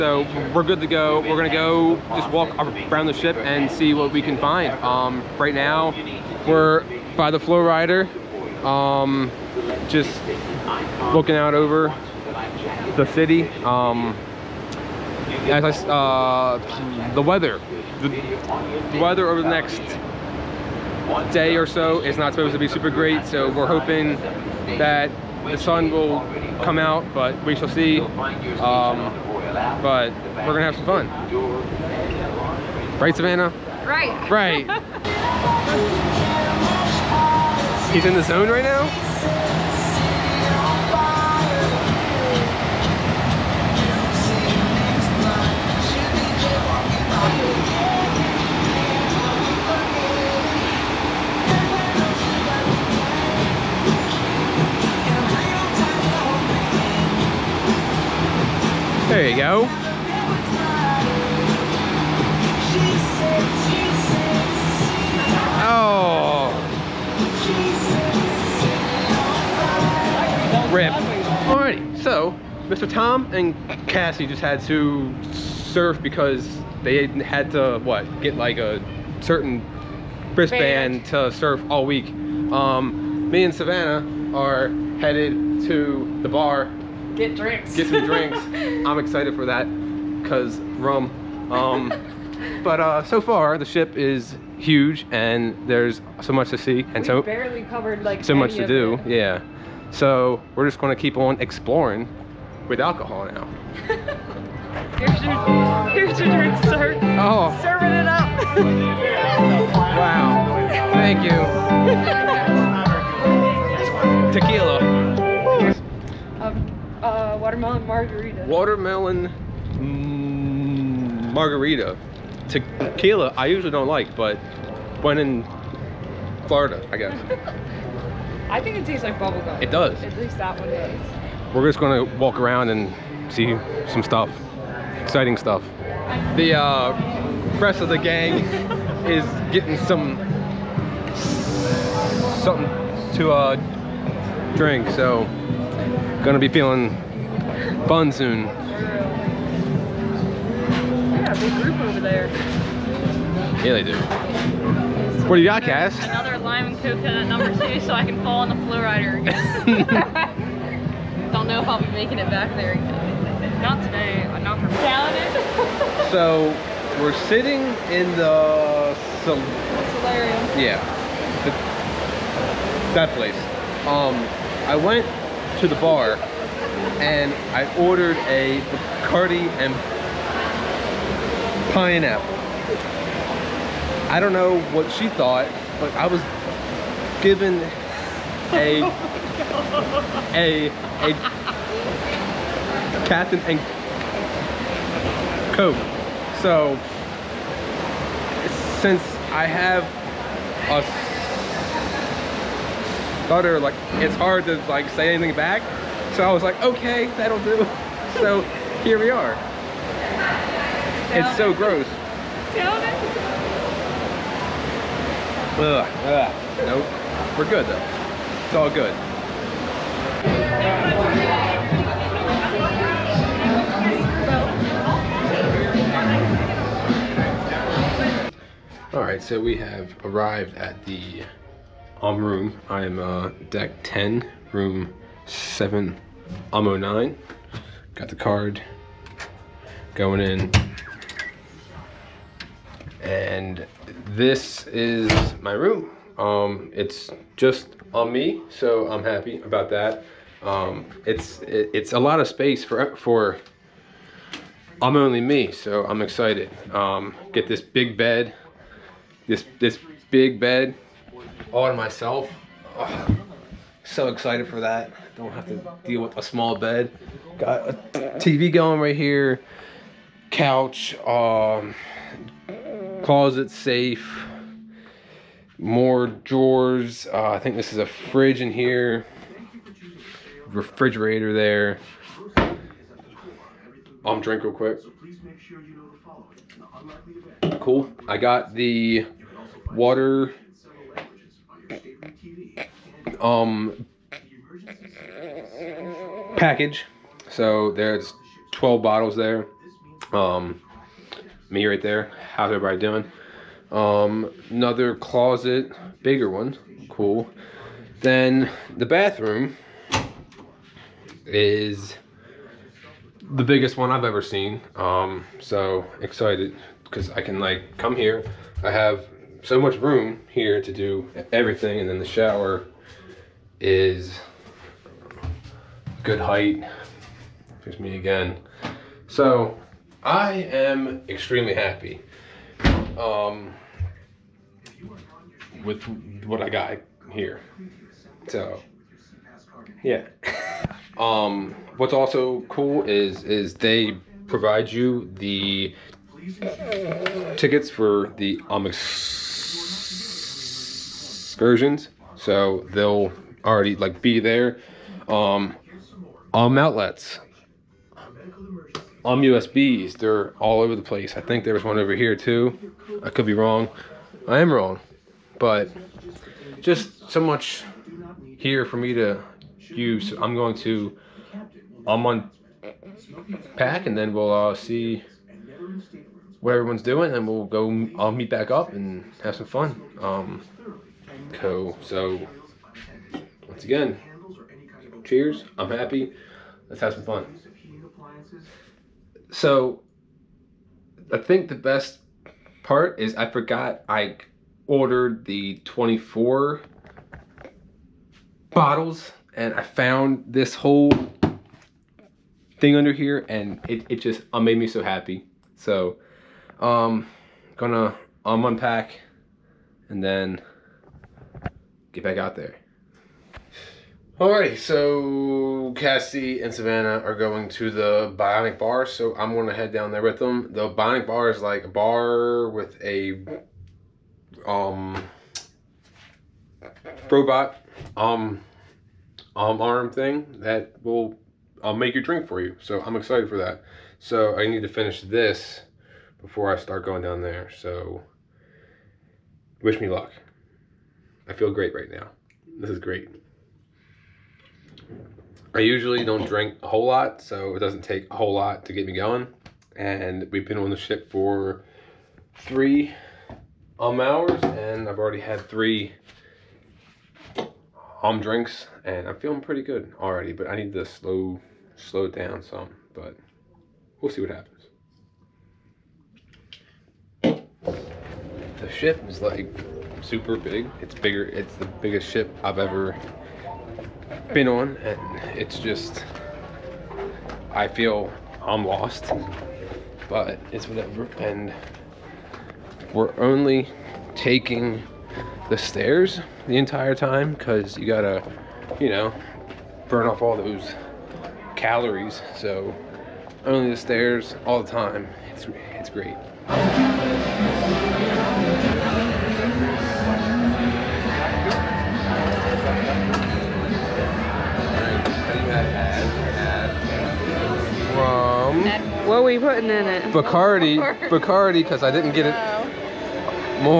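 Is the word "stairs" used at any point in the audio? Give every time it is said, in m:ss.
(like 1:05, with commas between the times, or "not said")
8:05, 8:13.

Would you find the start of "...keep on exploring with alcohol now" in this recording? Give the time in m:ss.
1:40.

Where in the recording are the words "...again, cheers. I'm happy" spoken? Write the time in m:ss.
6:23.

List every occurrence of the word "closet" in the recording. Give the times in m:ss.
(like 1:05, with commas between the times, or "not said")
4:33, 5:04.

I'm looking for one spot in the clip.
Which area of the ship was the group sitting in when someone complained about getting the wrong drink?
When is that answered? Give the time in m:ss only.
2:49.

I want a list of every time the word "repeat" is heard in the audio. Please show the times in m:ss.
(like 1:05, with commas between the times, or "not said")
not said.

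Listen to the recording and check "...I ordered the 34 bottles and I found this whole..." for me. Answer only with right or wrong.
wrong.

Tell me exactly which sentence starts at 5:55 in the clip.
Um, um outlets, um USBs, they're all over the place.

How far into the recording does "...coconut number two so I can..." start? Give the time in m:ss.
2:36.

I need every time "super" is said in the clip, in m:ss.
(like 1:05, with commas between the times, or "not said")
0:22, 7:50.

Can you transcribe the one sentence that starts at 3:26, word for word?
So I was like, okay, that'll do.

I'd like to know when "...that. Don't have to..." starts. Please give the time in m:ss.
4:24.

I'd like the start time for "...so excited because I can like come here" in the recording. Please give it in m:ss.
5:15.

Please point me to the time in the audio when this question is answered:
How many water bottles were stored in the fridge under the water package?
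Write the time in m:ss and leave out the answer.
4:58.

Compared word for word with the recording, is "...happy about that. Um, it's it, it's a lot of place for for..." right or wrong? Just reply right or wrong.
wrong.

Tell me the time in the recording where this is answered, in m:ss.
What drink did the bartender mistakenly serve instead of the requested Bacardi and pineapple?
3:13.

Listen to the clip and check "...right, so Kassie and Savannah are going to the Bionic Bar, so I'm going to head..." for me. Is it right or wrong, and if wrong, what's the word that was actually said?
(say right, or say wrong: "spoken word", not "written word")
right.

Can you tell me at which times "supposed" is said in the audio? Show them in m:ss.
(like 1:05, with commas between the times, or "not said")
0:22.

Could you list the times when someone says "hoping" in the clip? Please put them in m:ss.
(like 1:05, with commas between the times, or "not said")
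0:23.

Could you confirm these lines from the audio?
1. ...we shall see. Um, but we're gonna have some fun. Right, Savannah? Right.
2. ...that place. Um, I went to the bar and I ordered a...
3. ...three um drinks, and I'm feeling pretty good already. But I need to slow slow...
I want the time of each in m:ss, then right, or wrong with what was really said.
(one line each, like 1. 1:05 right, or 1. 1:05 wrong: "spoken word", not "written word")
1. 0:27 right
2. 2:52 right
3. 7:35 right.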